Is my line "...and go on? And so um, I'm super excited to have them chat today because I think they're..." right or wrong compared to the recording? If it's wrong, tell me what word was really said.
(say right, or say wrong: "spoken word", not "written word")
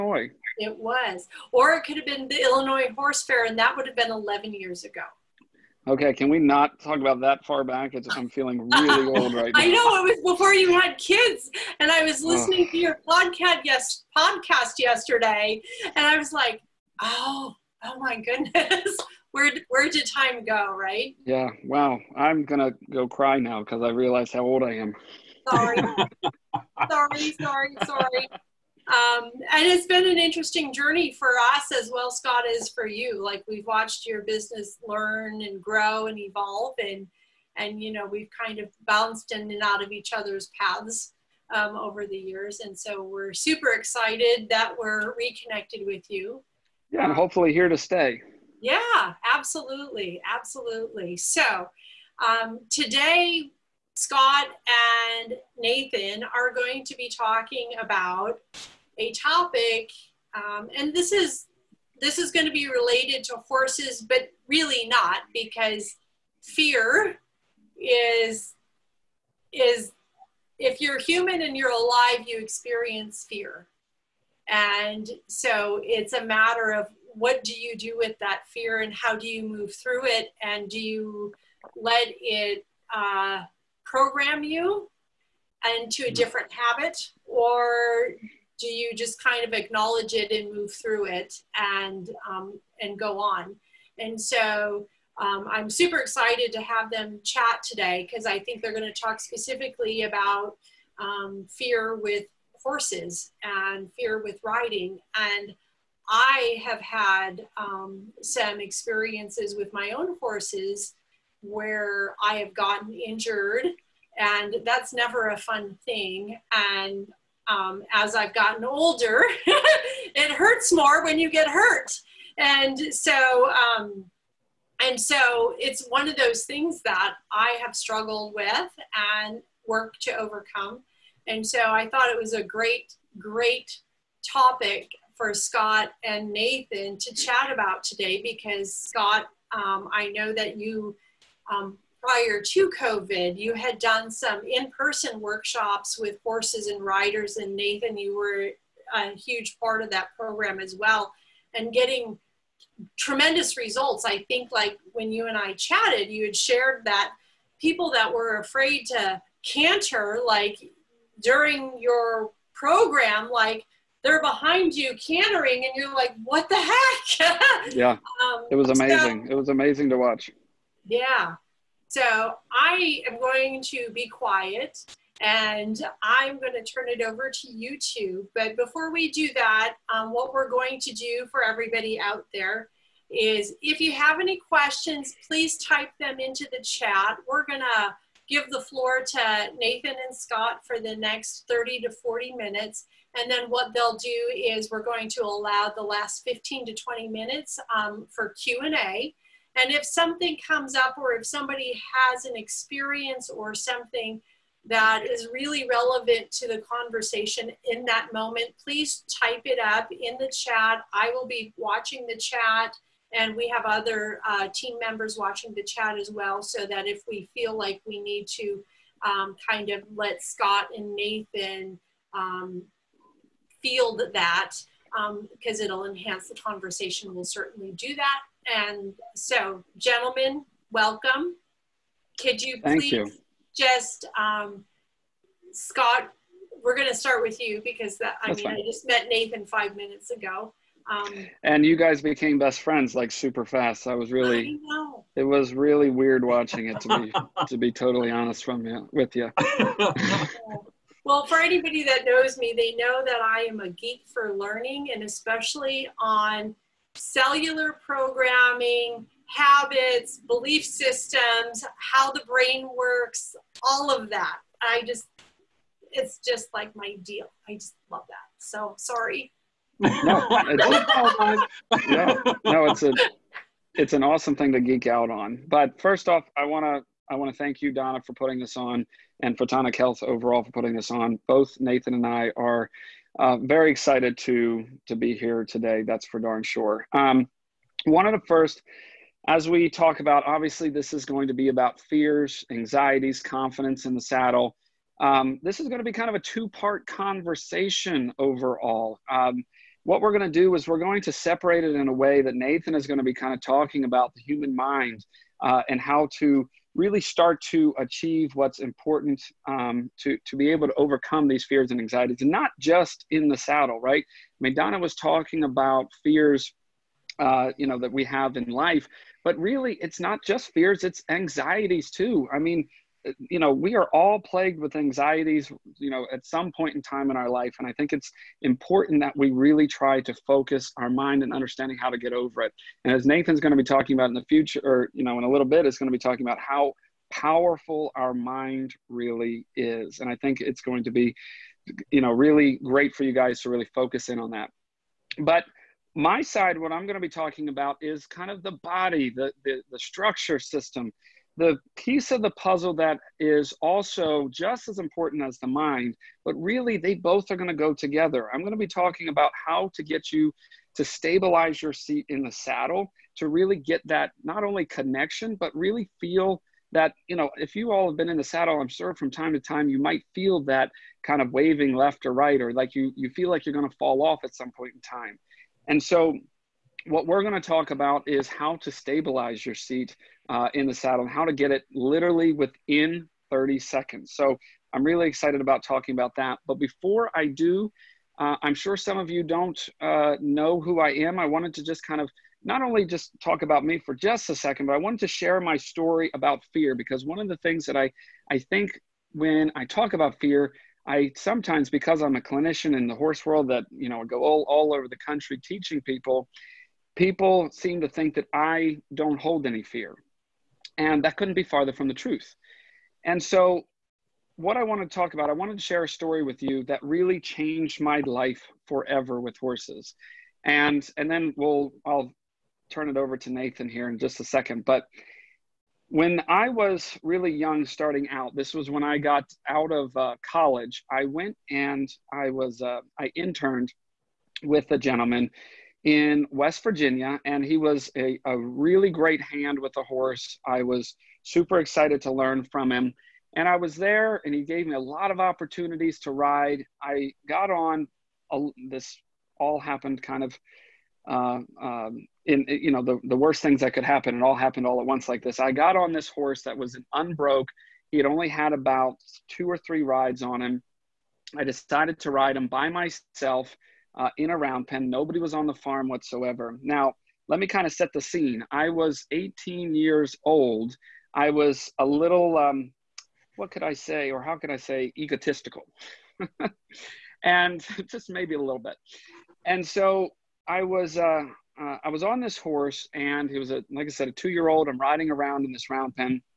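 right.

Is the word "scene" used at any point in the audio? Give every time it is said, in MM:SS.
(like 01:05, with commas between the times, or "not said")
07:48.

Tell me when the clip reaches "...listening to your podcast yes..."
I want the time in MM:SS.
00:12.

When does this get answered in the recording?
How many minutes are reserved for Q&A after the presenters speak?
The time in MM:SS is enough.
03:16.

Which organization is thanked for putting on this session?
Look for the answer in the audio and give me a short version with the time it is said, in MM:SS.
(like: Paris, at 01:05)
Photonic Health, at 04:39.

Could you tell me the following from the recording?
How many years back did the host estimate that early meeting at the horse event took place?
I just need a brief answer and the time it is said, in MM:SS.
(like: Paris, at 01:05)
11, at 00:04.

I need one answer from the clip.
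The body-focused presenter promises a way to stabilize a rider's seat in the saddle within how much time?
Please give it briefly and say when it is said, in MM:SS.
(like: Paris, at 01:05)
30 seconds, at 06:23.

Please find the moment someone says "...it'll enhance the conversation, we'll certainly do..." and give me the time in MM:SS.
03:45.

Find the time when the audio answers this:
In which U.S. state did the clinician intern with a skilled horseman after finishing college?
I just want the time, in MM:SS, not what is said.
07:16.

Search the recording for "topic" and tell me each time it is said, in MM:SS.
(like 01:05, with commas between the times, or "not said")
00:59, 02:14.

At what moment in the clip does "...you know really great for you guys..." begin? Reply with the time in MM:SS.
05:41.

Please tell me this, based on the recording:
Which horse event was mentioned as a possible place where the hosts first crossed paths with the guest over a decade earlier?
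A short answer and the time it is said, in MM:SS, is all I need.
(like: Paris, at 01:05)
Illinois Horse Fair, at 00:02.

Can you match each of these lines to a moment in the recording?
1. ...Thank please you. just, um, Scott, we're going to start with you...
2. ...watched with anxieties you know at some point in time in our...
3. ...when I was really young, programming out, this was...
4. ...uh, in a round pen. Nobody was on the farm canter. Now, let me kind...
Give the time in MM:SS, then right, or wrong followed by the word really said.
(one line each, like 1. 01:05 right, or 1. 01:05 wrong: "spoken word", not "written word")
1. 03:52 right
2. 05:24 wrong: "plagued", not "watched"
3. 07:05 wrong: "starting", not "programming"
4. 07:43 wrong: "whatsoever", not "canter".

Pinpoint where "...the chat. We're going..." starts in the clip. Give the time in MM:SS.
03:06.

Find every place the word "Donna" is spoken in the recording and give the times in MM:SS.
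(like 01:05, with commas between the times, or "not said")
04:37, 05:14.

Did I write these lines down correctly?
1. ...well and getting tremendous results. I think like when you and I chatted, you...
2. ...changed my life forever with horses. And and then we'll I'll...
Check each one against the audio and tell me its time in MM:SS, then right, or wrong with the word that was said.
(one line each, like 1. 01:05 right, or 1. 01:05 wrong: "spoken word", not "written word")
1. 02:30 right
2. 06:57 right.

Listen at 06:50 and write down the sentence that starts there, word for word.
And that couldn't be farther from the truth.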